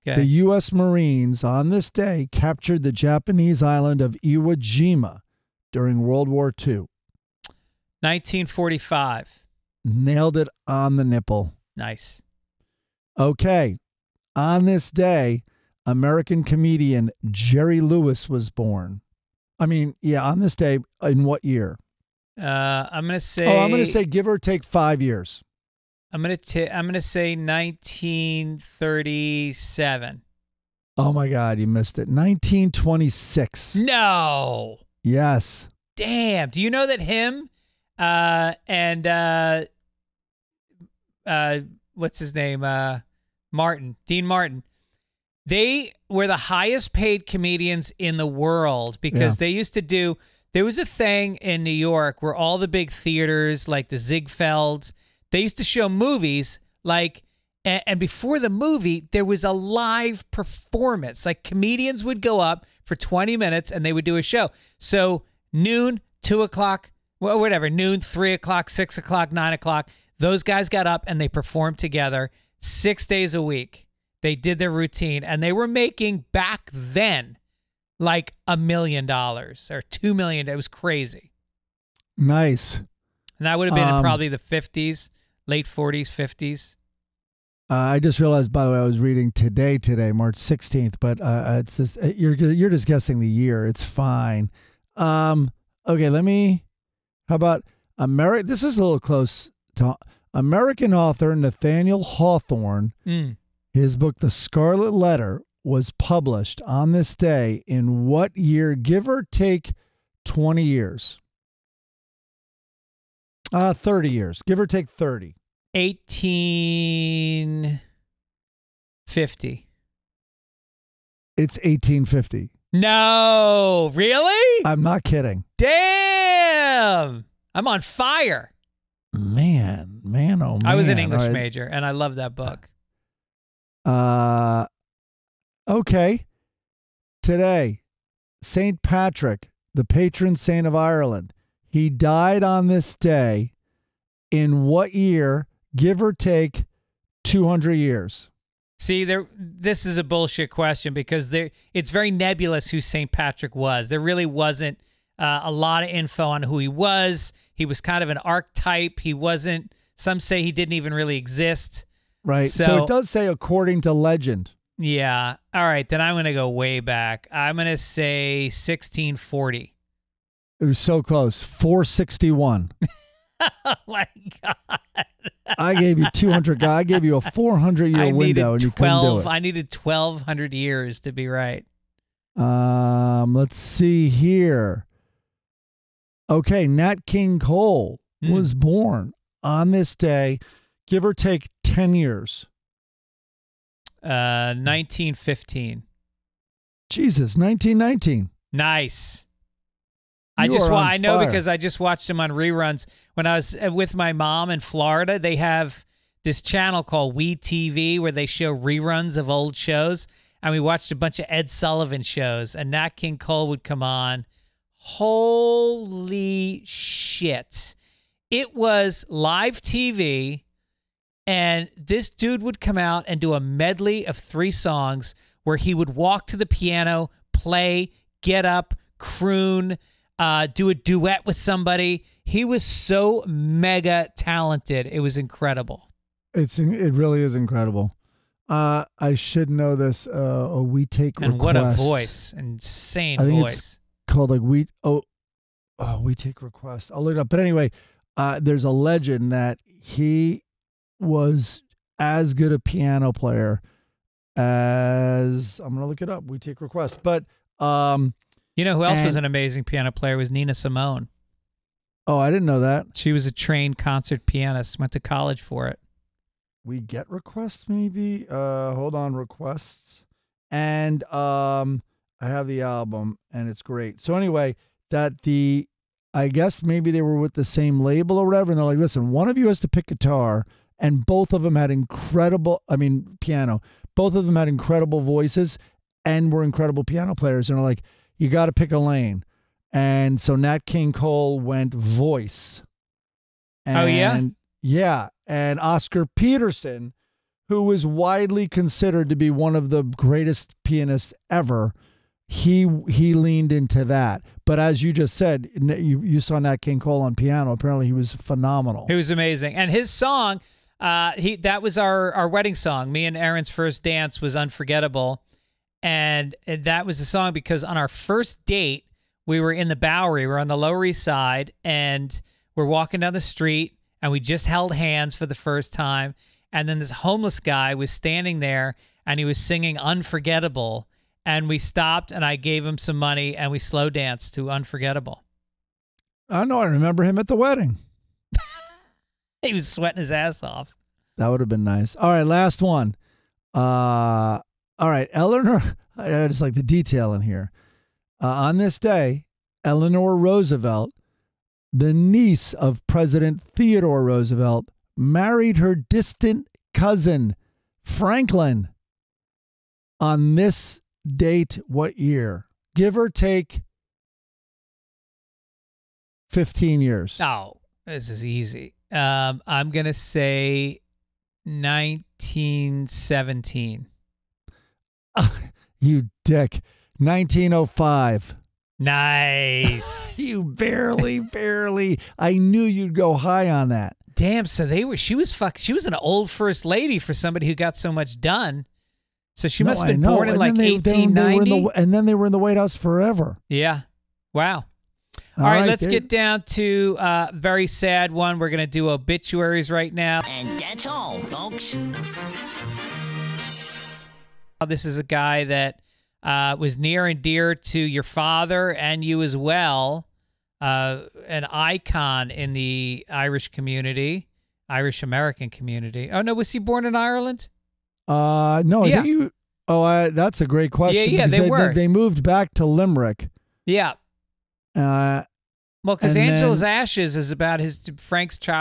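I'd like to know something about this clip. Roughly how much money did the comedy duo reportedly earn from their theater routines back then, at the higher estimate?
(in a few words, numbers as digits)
2 million dollars.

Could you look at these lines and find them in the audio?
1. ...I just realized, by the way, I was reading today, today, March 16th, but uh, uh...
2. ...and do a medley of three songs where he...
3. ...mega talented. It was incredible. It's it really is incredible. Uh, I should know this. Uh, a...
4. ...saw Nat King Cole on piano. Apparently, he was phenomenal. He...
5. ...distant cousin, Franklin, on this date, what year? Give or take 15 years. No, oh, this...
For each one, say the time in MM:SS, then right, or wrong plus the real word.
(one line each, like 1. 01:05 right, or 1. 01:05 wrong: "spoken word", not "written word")
1. 01:27 right
2. 03:43 right
3. 03:53 right
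4. 05:06 right
5. 05:55 right.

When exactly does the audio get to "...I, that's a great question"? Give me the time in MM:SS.
06:59.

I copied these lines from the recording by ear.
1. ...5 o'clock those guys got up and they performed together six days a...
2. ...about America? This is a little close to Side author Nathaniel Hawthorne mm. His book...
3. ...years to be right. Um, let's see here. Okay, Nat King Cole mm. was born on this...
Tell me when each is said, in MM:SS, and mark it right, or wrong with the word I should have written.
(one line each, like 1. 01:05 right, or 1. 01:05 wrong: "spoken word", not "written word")
1. 01:09 wrong: "9", not "5"
2. 01:37 wrong: "American", not "Side"
3. 03:00 right.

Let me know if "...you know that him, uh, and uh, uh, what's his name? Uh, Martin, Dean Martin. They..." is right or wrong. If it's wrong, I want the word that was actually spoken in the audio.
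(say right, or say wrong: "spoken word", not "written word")
right.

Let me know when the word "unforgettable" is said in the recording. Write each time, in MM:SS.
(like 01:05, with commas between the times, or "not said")
05:14, 05:29, 05:34.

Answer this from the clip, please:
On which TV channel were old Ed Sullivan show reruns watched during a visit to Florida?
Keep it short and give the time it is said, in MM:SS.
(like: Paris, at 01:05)
We TV, at 03:27.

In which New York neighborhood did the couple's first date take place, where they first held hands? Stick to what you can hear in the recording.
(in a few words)
The Bowery.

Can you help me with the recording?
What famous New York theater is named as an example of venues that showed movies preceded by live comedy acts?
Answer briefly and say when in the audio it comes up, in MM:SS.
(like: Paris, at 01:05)
Ziegfelds, at 00:53.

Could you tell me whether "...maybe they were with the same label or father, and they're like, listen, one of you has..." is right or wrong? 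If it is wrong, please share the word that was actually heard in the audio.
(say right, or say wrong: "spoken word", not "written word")
wrong: "whatever", not "father".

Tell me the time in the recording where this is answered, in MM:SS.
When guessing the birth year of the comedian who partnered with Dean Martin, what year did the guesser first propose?
00:27.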